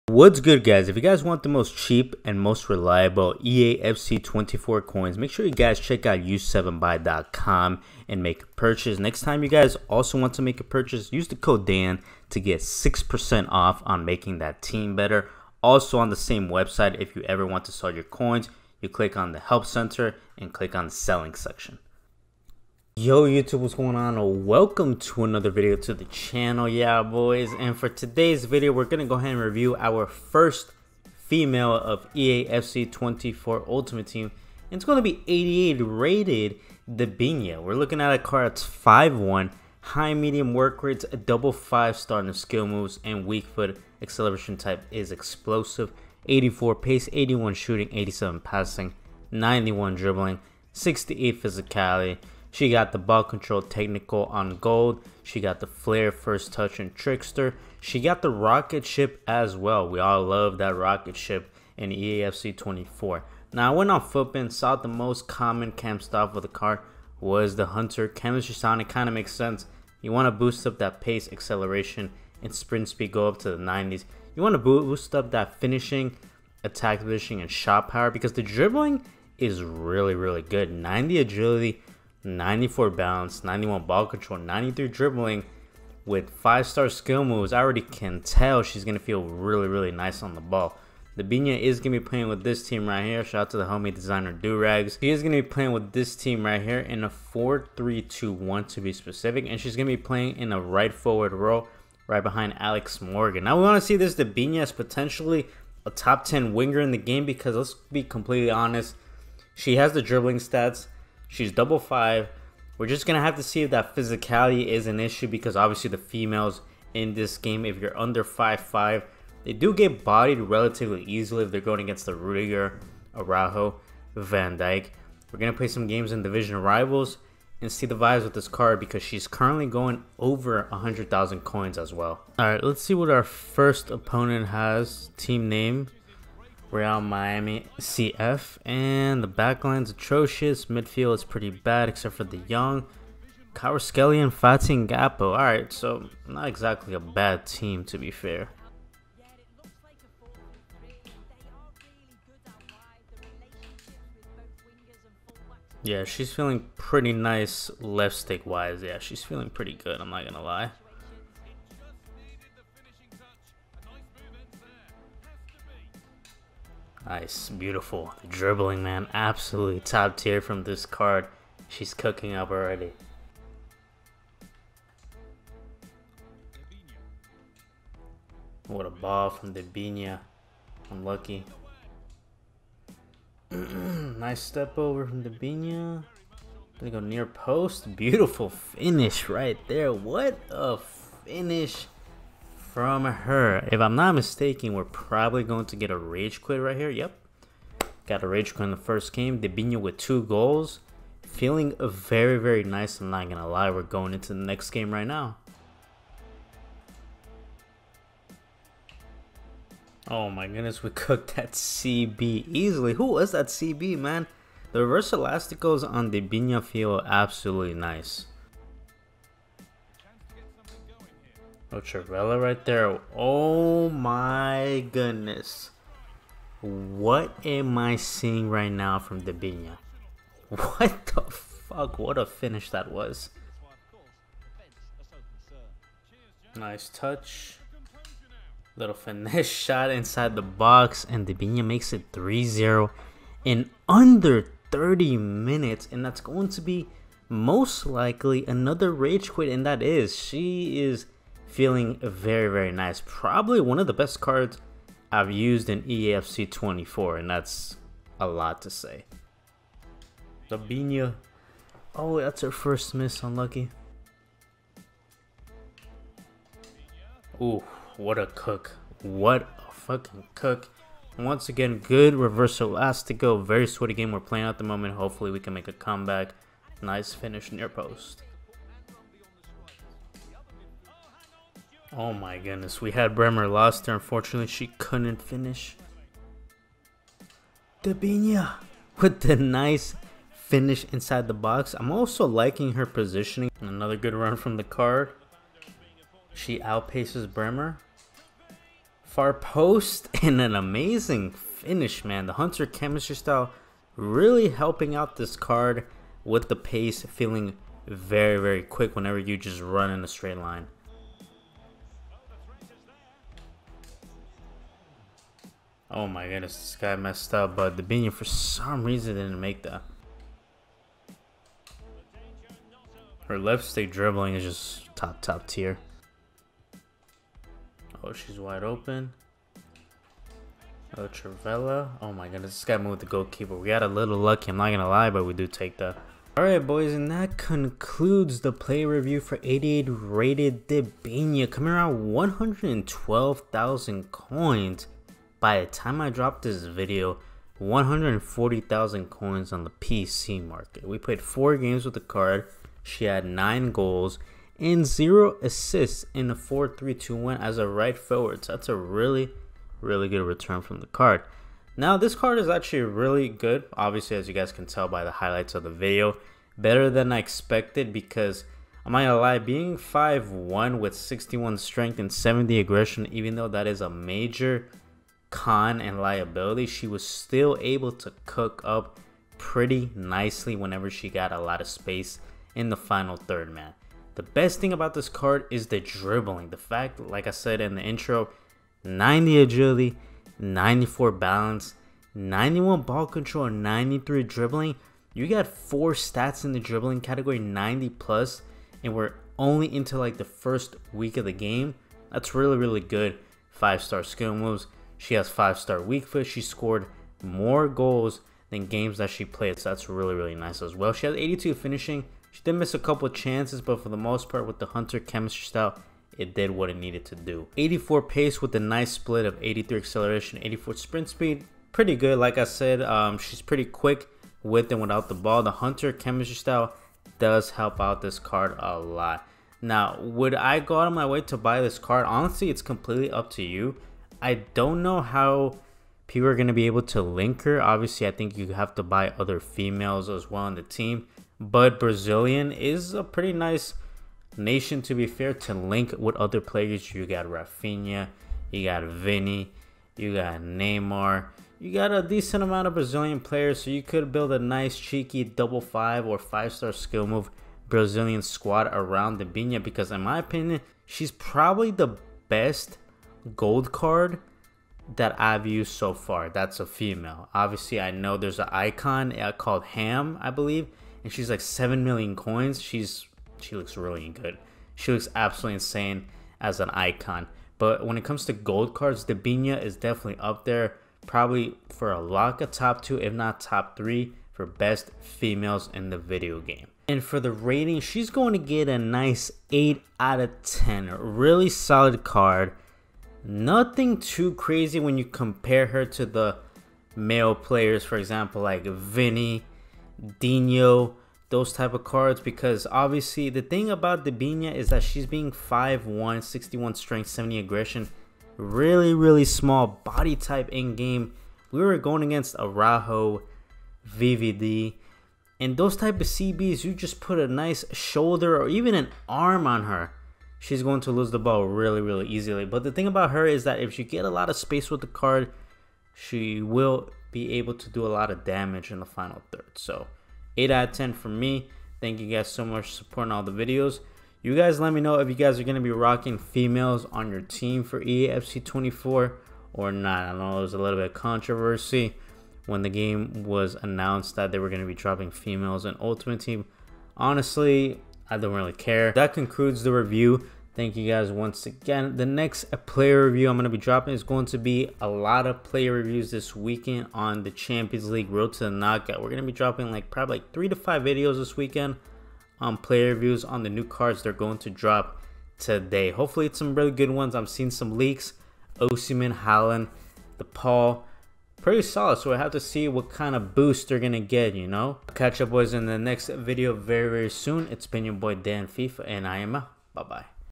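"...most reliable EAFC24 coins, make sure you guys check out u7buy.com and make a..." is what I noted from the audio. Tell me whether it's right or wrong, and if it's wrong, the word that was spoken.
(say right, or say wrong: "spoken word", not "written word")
right.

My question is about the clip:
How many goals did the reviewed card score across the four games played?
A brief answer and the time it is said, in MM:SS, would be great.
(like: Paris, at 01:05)
9, at 05:53.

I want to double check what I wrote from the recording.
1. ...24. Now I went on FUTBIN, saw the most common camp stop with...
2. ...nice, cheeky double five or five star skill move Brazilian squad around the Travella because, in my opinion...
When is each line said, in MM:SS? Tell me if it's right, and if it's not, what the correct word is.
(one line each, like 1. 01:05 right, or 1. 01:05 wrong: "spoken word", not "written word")
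1. 01:02 right
2. 07:34 wrong: "Debinha", not "Travella".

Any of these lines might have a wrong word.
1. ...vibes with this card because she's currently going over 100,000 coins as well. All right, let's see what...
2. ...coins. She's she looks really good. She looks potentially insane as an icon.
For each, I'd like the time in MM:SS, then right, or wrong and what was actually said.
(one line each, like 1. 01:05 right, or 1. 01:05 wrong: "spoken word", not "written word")
1. 02:07 right
2. 07:52 wrong: "absolutely", not "potentially".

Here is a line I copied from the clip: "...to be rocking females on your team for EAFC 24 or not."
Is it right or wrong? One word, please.
right.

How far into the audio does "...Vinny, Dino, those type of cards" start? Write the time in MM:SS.
08:18.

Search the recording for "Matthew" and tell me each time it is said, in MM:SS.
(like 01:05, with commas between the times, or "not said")
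not said.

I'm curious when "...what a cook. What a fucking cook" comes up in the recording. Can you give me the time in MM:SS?
04:27.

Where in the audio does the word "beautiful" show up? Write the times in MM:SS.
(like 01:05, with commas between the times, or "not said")
02:47, 03:07.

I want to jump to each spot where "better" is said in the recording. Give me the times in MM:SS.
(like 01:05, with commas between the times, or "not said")
00:14, 06:06.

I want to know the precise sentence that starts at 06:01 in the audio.
Now, this card is actually really good.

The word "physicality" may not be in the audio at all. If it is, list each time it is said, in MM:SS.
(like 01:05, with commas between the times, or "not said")
00:51, 01:53.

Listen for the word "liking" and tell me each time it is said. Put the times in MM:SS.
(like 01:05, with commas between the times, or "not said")
04:52.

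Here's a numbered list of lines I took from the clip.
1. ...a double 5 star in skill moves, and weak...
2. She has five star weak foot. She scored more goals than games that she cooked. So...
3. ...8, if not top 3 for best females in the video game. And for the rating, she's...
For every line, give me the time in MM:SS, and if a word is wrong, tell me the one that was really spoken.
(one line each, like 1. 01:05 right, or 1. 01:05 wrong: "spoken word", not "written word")
1. 00:41 right
2. 06:45 wrong: "played", not "cooked"
3. 08:02 wrong: "2", not "8".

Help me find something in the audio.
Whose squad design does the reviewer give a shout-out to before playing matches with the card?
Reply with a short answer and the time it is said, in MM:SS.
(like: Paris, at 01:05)
Durags, at 01:34.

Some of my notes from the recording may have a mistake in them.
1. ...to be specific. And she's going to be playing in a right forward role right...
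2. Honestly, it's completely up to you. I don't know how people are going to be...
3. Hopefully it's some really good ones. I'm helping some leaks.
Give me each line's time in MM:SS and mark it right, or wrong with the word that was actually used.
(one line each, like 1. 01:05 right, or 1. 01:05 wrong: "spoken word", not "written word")
1. 01:38 right
2. 07:12 right
3. 09:25 wrong: "seeing", not "helping".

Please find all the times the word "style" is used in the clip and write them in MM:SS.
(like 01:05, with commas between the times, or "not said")
05:03, 06:55, 07:06.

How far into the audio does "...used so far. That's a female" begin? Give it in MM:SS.
07:45.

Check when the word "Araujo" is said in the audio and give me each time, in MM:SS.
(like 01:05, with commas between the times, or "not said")
02:03, 08:32.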